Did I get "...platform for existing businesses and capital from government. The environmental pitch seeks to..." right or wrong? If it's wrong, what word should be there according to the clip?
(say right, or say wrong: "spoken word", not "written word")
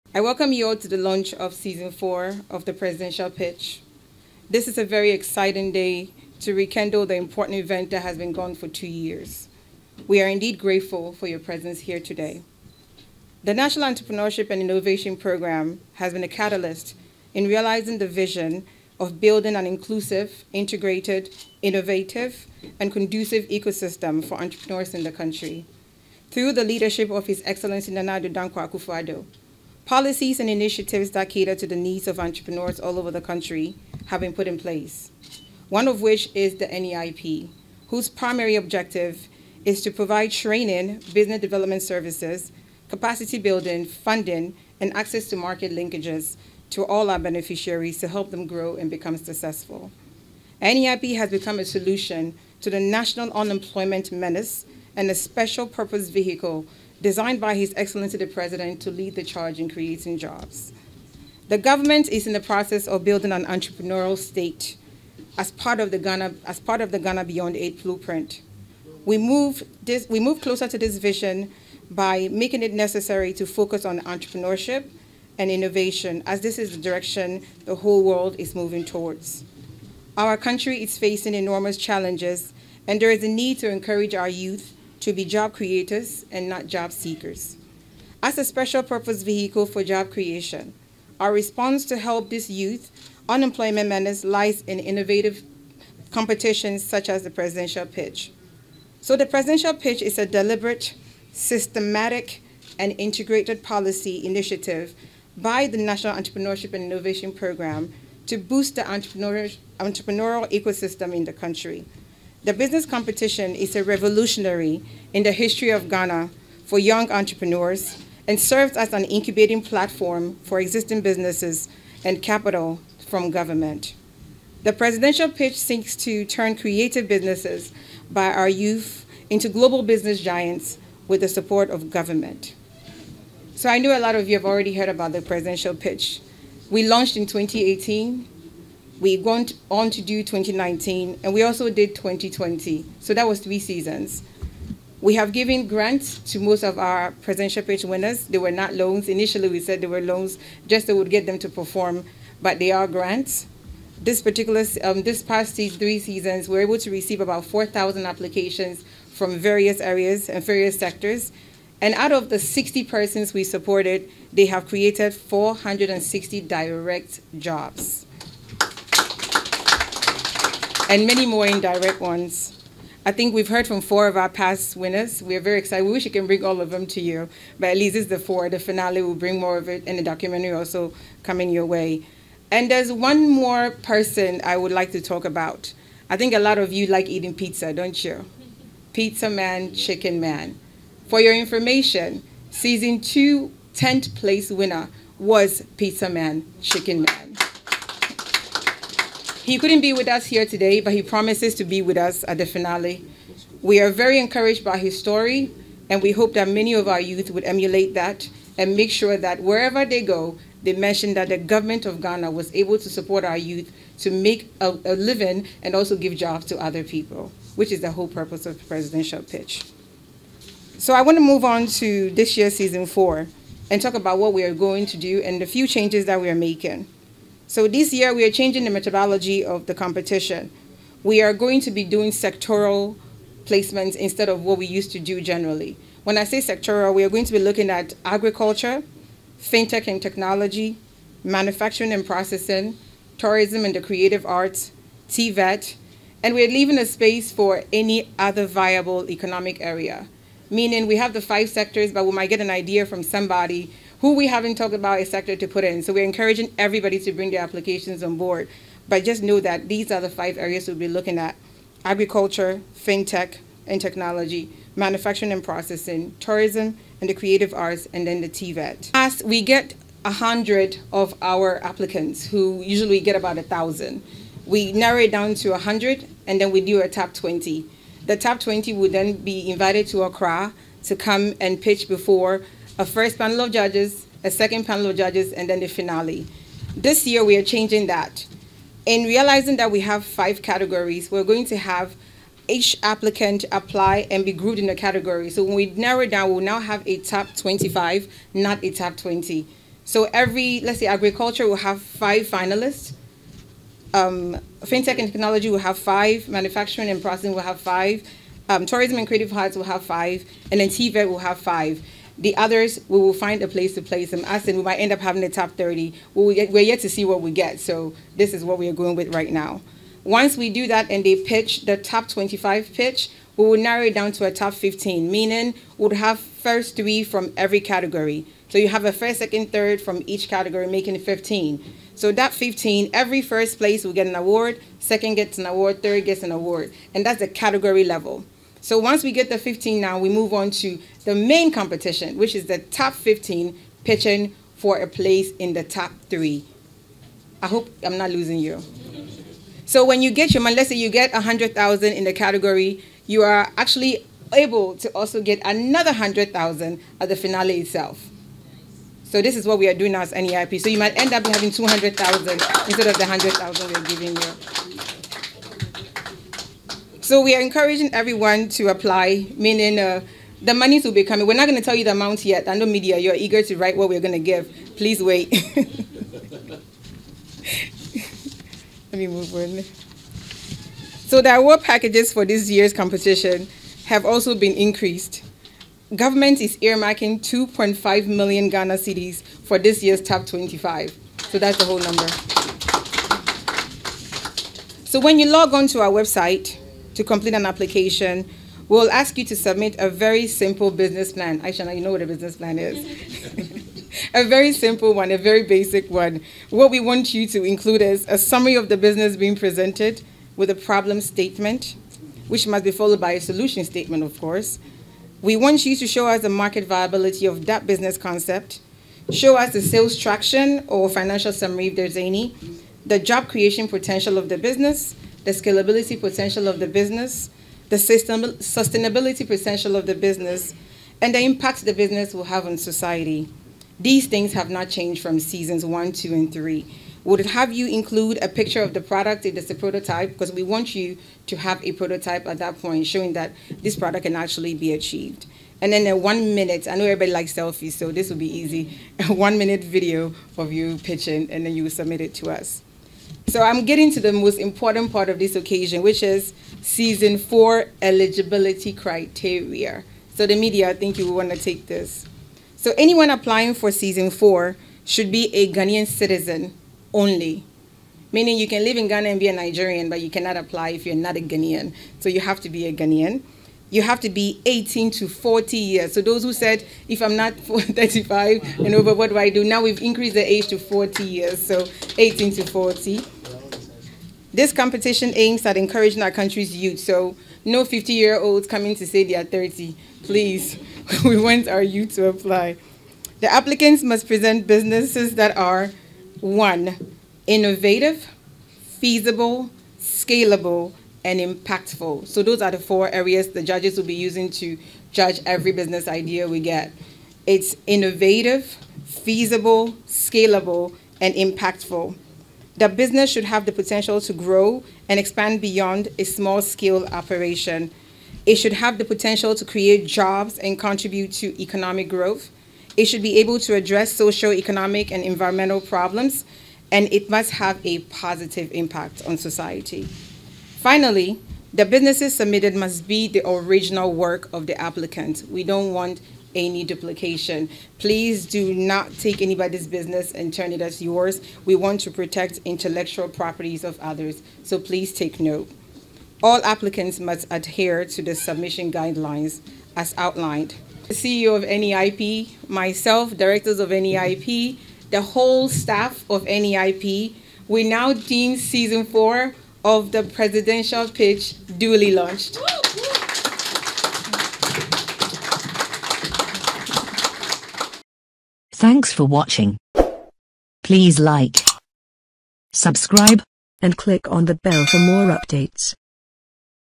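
wrong: "presidential", not "environmental".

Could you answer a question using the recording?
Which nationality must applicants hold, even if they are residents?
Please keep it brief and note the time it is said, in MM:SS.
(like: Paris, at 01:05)
Nigerian, at 07:49.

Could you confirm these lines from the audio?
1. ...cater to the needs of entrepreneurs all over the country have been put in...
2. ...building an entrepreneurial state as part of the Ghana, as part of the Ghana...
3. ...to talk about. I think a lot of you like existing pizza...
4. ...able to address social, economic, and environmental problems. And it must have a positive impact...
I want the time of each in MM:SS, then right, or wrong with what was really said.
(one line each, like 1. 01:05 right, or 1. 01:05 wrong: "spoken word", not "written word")
1. 00:31 right
2. 01:03 right
3. 03:04 wrong: "eating", not "existing"
4. 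08:43 right.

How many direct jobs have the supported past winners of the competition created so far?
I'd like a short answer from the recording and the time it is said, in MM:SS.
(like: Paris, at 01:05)
460, at 02:45.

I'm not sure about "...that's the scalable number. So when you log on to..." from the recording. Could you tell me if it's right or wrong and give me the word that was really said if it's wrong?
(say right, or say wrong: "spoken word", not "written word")
wrong: "whole", not "scalable".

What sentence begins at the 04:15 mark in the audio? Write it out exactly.
So we're encouraging everybody to bring their applications on board.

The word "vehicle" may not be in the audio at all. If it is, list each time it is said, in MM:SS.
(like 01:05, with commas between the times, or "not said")
00:56, 01:29.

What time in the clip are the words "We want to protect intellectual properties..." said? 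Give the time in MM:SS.
09:01.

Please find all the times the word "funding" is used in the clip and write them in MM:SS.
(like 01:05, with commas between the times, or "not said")
00:43.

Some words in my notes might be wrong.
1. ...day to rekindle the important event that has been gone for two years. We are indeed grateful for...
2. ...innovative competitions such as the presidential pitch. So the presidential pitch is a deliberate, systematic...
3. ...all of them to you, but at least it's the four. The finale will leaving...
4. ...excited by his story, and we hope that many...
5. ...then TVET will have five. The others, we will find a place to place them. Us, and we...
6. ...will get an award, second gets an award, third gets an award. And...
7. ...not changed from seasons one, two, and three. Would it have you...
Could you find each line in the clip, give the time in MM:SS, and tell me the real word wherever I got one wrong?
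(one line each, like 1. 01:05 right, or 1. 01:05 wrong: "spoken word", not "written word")
1. 00:05 right
2. 01:34 right
3. 02:56 wrong: "bring", not "leaving"
4. 03:24 wrong: "encouraged", not "excited"
5. 05:10 right
6. 05:33 right
7. 07:14 right.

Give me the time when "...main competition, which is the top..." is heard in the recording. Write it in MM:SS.
05:41.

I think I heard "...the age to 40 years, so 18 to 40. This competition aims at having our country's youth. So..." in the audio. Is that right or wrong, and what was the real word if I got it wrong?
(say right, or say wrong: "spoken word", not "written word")
wrong: "encouraging", not "having".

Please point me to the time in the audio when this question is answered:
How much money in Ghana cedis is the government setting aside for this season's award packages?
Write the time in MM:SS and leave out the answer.
06:27.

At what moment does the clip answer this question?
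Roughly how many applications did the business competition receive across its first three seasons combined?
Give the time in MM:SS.
02:37.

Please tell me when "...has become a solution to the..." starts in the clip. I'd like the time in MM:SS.
00:51.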